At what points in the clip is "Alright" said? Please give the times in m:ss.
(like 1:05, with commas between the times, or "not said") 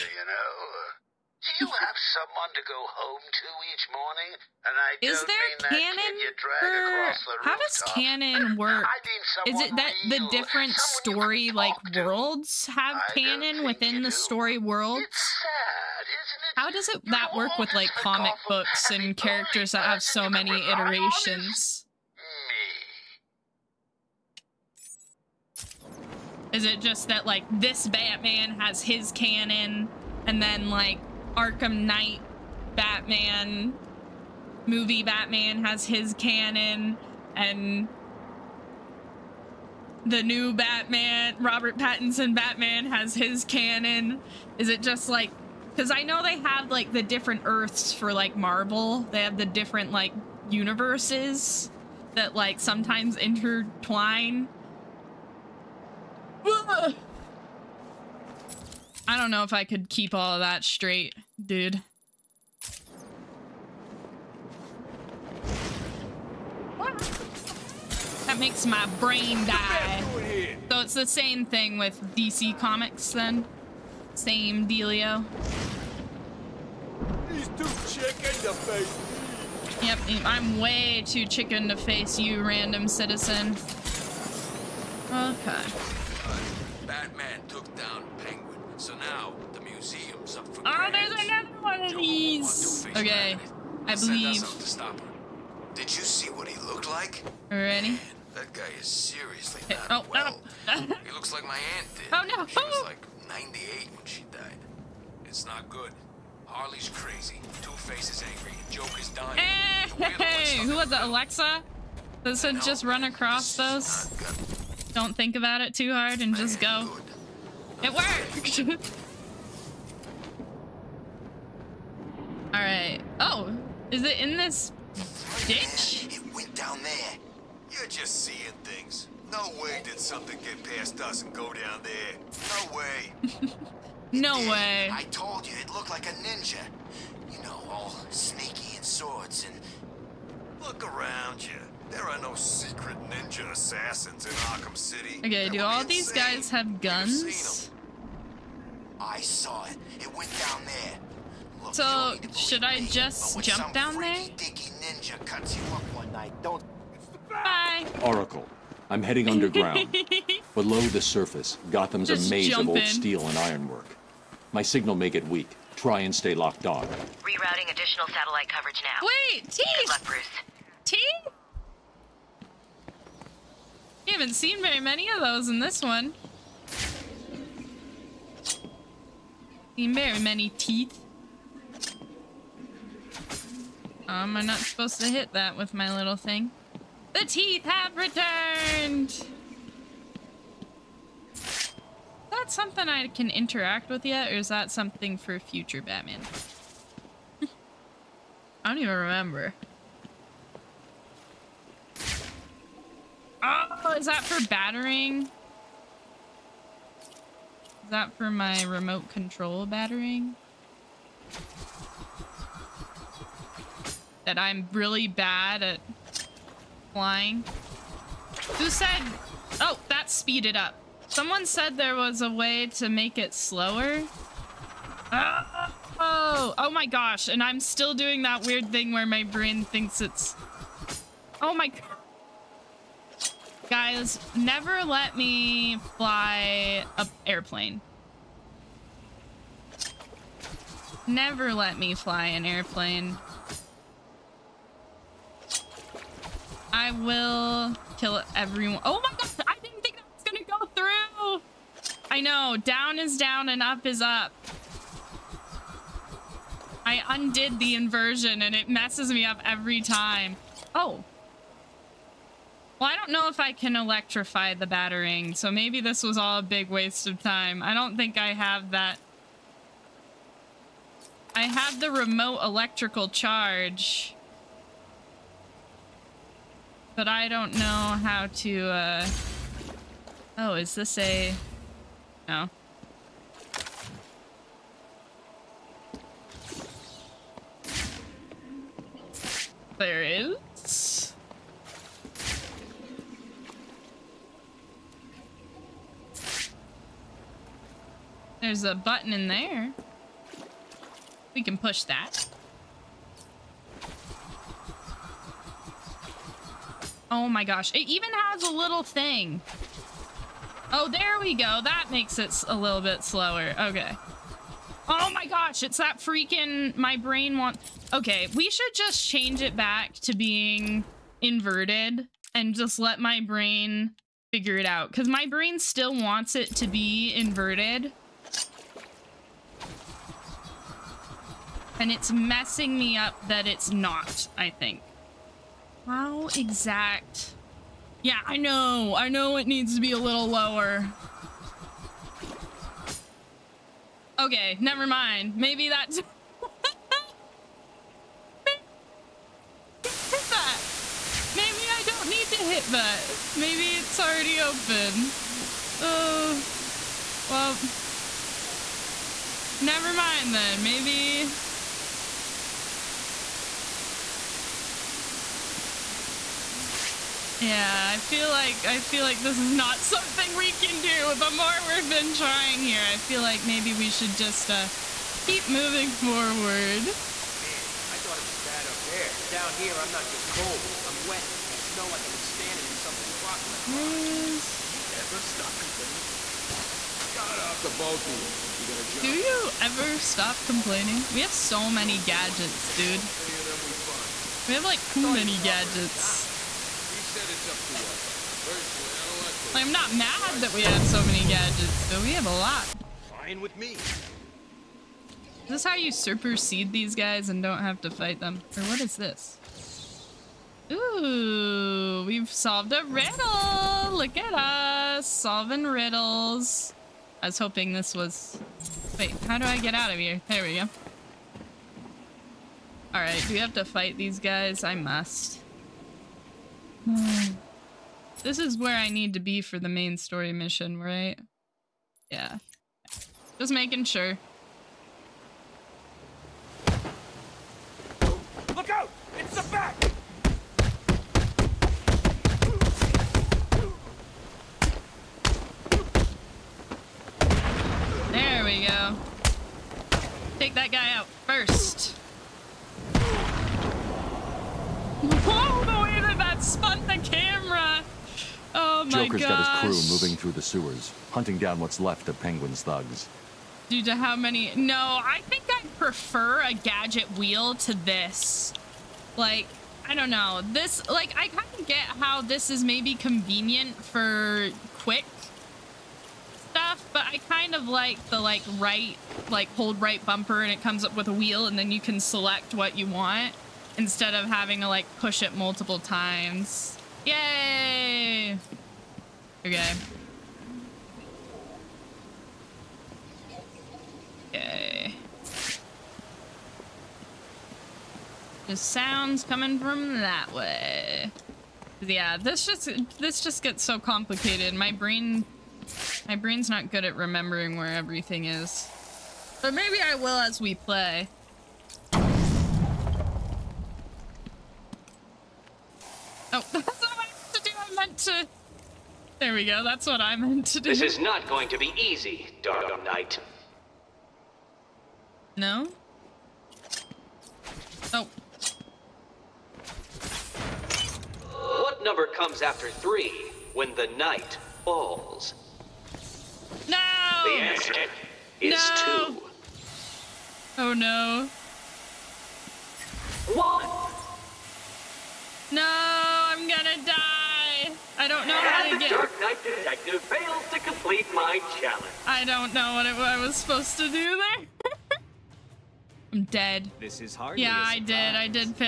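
2:02, 7:02.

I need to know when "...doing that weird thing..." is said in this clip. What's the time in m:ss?
3:47.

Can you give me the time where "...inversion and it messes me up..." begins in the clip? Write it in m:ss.
4:17.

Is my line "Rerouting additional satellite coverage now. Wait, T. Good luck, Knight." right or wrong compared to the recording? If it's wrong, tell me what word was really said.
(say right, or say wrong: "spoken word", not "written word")
wrong: "Bruce", not "Knight".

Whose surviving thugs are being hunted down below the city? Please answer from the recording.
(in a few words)
Penguin.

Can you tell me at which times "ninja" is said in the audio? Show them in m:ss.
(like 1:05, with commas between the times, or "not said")
2:16, 2:23, 2:34.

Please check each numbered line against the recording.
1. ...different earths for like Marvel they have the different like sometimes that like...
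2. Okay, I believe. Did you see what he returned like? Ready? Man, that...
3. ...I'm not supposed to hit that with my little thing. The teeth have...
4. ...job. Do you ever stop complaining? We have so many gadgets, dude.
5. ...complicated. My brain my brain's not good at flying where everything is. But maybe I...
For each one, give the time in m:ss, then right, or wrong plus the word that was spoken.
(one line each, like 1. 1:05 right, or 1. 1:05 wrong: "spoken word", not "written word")
1. 0:47 wrong: "universes", not "sometimes"
2. 1:32 wrong: "looked", not "returned"
3. 3:04 right
4. 6:28 right
5. 8:23 wrong: "remembering", not "flying".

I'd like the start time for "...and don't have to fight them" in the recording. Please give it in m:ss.
6:47.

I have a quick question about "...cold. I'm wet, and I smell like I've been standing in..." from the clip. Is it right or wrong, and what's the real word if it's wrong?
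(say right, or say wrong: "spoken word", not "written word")
right.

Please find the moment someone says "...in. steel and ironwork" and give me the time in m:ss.
2:42.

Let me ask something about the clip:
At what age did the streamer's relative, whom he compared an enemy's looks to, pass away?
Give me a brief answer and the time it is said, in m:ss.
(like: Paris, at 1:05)
98, at 1:43.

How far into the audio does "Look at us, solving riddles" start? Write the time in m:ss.
6:53.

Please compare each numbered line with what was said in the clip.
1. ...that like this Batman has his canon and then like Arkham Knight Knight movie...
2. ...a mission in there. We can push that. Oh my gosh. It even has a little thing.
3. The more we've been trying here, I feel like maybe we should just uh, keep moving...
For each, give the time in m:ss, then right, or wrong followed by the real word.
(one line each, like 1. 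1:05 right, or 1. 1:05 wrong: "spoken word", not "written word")
1. 0:27 wrong: "Batman", not "Knight"
2. 4:58 wrong: "button", not "mission"
3. 6:11 right.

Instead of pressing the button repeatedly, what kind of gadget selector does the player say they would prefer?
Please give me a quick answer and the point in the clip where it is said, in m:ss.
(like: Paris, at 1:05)
A gadget wheel, at 7:46.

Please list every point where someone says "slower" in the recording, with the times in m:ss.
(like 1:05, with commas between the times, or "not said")
3:43, 5:13.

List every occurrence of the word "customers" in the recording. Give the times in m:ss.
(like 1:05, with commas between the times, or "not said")
not said.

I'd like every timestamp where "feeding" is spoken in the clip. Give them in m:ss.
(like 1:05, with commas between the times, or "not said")
not said.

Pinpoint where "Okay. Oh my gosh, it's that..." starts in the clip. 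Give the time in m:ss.
5:13.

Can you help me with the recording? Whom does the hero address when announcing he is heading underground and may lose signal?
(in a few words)
Oracle.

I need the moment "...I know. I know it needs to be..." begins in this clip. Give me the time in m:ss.
5:38.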